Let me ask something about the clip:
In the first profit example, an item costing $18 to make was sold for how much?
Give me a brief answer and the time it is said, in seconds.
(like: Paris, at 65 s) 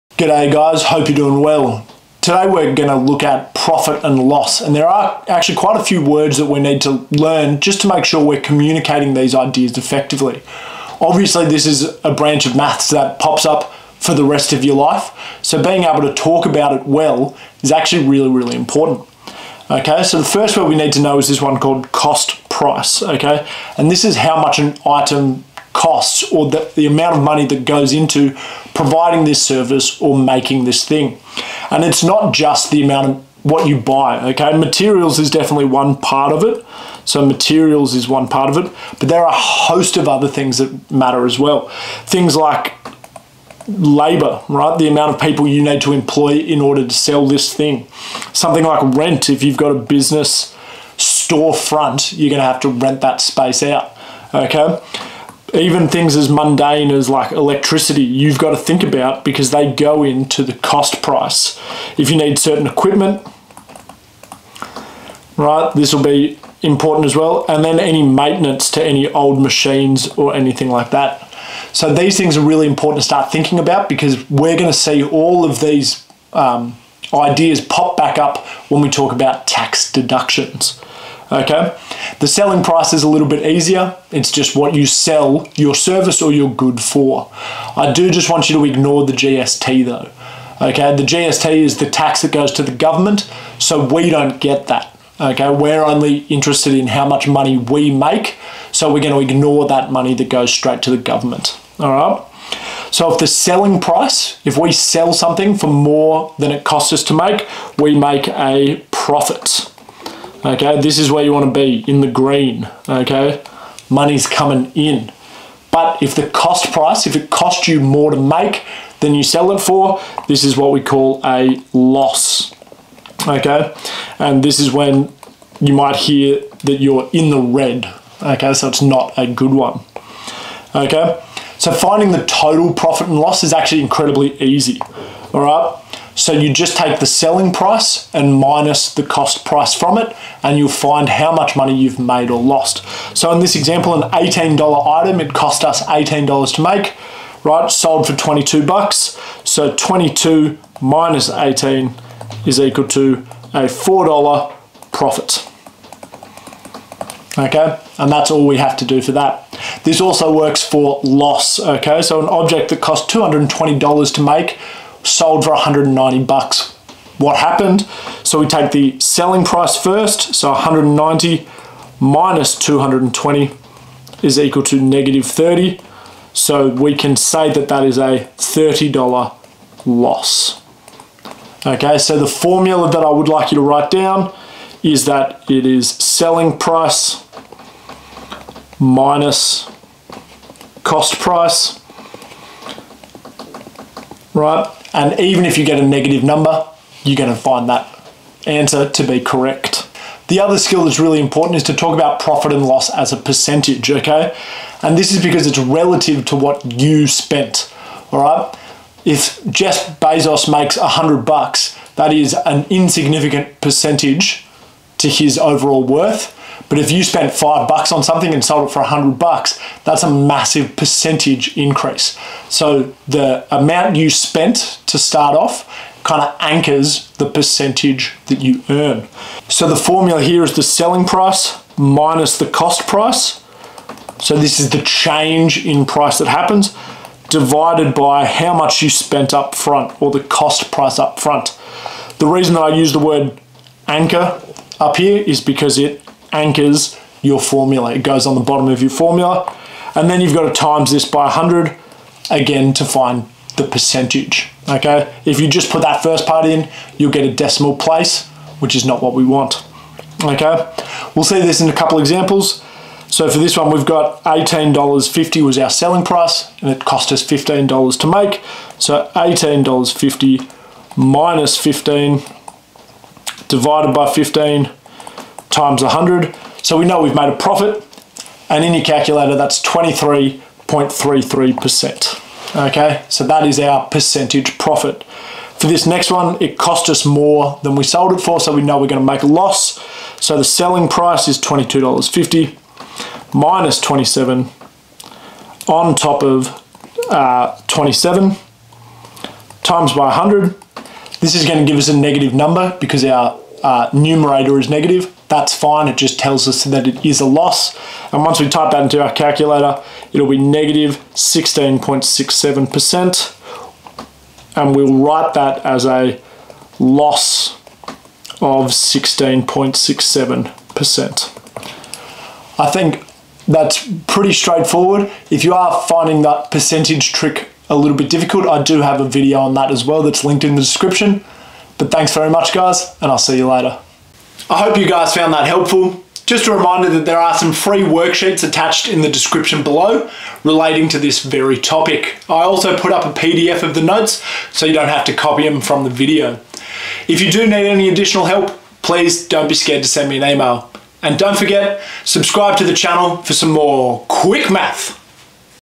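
$22, at 148 s.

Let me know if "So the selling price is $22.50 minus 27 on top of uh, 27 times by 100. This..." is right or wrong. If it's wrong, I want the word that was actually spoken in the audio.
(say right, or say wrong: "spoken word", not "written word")
right.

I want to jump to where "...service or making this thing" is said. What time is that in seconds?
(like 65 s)
29 s.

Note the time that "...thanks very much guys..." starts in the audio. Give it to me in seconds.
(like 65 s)
331 s.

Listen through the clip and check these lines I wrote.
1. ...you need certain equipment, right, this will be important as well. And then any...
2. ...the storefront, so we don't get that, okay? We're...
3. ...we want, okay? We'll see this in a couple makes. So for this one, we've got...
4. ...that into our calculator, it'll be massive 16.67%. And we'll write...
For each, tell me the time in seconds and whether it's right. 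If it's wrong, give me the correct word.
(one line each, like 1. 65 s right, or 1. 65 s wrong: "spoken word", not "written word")
1. 62 s right
2. 92 s wrong: "government", not "storefront"
3. 259 s wrong: "examples", not "makes"
4. 308 s wrong: "negative", not "massive".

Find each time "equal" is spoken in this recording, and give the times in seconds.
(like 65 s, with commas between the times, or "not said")
152 s, 174 s.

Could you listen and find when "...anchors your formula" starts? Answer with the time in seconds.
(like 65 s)
246 s.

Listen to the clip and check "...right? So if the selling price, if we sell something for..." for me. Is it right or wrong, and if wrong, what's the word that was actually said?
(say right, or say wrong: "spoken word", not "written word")
right.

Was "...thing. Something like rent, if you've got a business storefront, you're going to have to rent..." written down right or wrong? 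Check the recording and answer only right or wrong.
right.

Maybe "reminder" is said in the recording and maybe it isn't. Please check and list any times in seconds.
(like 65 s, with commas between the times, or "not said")
336 s.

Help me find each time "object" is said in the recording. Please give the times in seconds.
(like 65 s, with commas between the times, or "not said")
162 s.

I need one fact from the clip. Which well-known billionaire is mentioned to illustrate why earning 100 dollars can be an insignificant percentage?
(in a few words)
Jeff Bezos.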